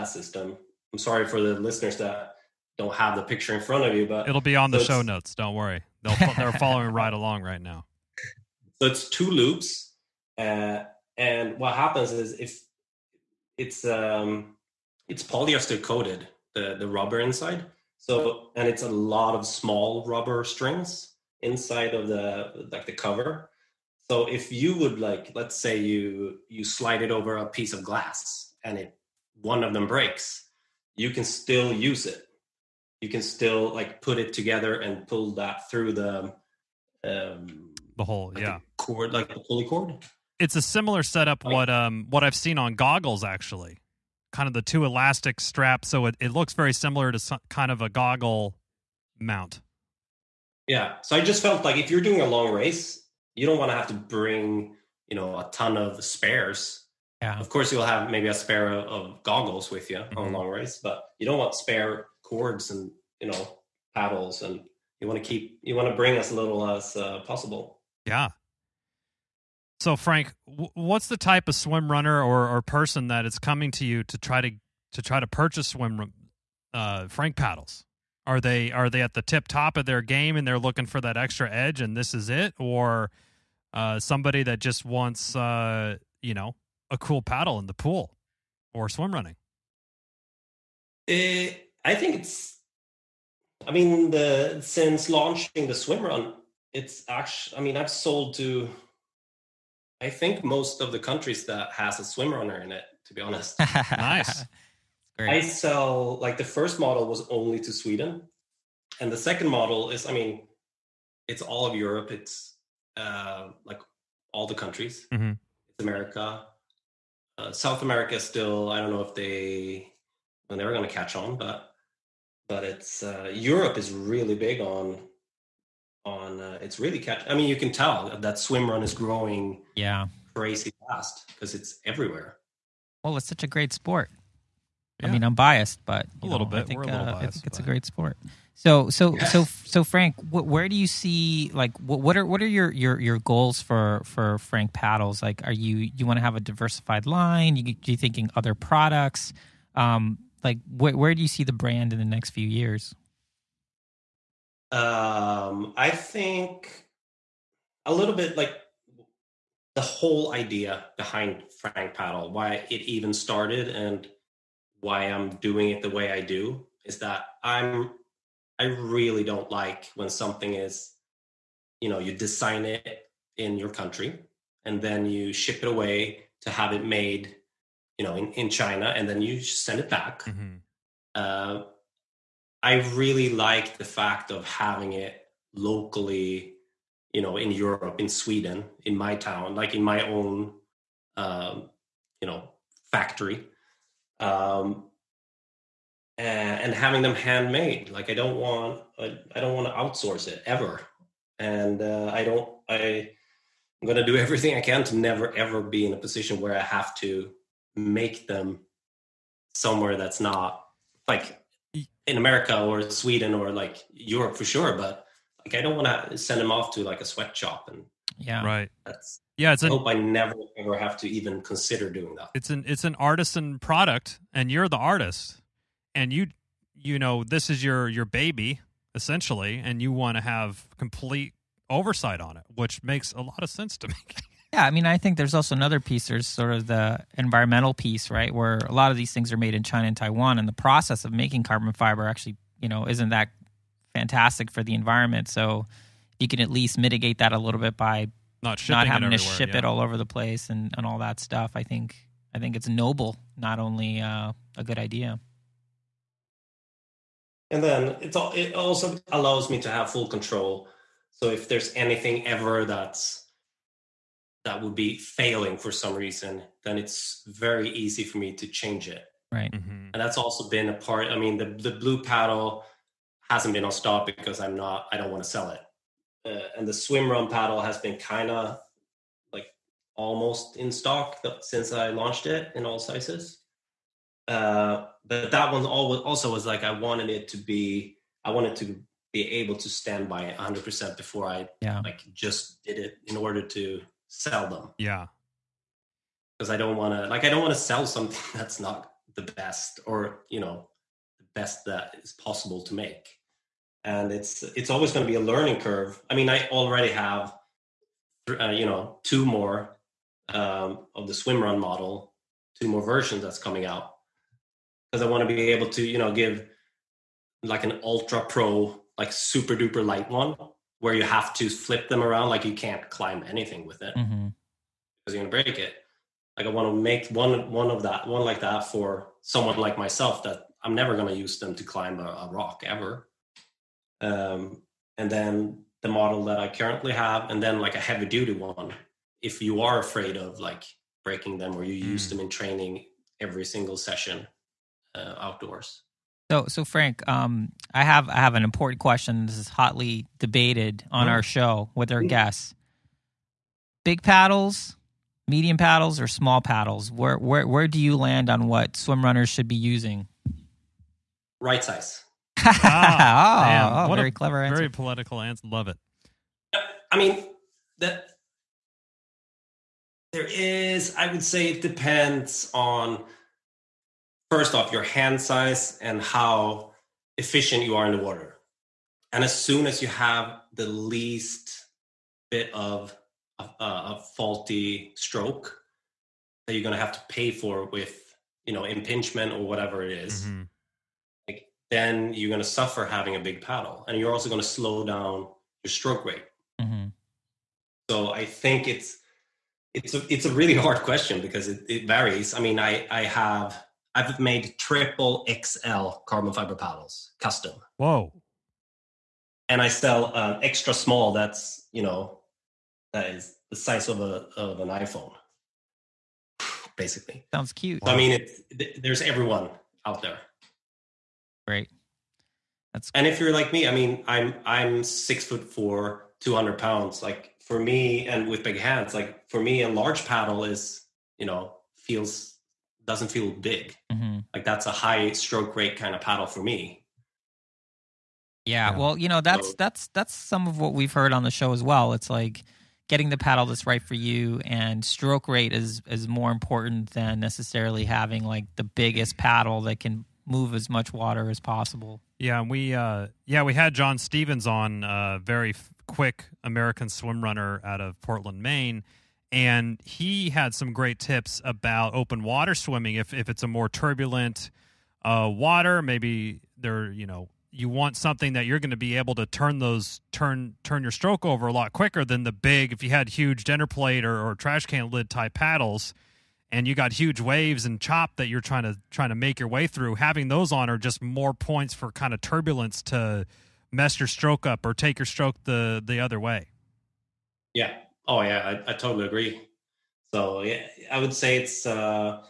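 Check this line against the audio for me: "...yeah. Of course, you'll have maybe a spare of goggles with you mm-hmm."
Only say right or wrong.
right.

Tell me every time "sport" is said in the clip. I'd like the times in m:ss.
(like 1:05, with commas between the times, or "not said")
2:13, 2:17.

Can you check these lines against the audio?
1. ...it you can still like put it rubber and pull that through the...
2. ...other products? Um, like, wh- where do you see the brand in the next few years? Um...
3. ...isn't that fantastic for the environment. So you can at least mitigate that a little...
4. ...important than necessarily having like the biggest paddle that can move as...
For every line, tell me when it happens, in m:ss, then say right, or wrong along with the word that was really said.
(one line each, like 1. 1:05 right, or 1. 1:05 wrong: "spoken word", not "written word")
1. 0:32 wrong: "together", not "rubber"
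2. 2:28 right
3. 4:02 right
4. 7:26 right.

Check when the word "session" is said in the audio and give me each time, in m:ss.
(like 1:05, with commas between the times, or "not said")
5:43.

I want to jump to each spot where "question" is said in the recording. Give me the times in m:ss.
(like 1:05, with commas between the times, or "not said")
5:48, 6:40.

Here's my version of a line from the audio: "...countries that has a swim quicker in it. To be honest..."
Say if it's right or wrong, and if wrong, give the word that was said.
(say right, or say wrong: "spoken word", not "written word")
wrong: "runner", not "quicker".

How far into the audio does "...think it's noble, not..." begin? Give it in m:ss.
4:12.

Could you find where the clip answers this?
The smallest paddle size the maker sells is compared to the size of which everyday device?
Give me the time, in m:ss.
6:54.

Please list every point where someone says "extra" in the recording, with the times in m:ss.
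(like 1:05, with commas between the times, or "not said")
1:21, 6:50.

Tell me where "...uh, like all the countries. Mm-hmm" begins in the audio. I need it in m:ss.
1:52.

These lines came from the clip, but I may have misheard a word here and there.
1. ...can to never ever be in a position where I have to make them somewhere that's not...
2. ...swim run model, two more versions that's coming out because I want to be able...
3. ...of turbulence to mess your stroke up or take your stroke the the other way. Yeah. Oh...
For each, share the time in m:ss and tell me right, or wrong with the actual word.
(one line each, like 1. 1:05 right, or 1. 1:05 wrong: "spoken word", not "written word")
1. 3:24 right
2. 5:11 right
3. 8:02 right.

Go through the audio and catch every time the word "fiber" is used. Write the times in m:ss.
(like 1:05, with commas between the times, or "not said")
4:01, 6:46.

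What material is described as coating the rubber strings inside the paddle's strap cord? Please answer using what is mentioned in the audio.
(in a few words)
Polyester.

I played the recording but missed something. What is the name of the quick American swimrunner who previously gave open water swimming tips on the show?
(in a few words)
John Stevens.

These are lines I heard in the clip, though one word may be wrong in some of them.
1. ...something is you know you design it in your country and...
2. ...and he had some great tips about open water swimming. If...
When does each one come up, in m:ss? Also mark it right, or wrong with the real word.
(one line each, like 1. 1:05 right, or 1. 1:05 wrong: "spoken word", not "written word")
1. 2:50 right
2. 7:39 right.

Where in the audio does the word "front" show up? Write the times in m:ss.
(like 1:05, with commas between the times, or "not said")
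0:03.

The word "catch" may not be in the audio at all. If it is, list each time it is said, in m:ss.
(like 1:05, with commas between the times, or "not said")
2:00, 2:06.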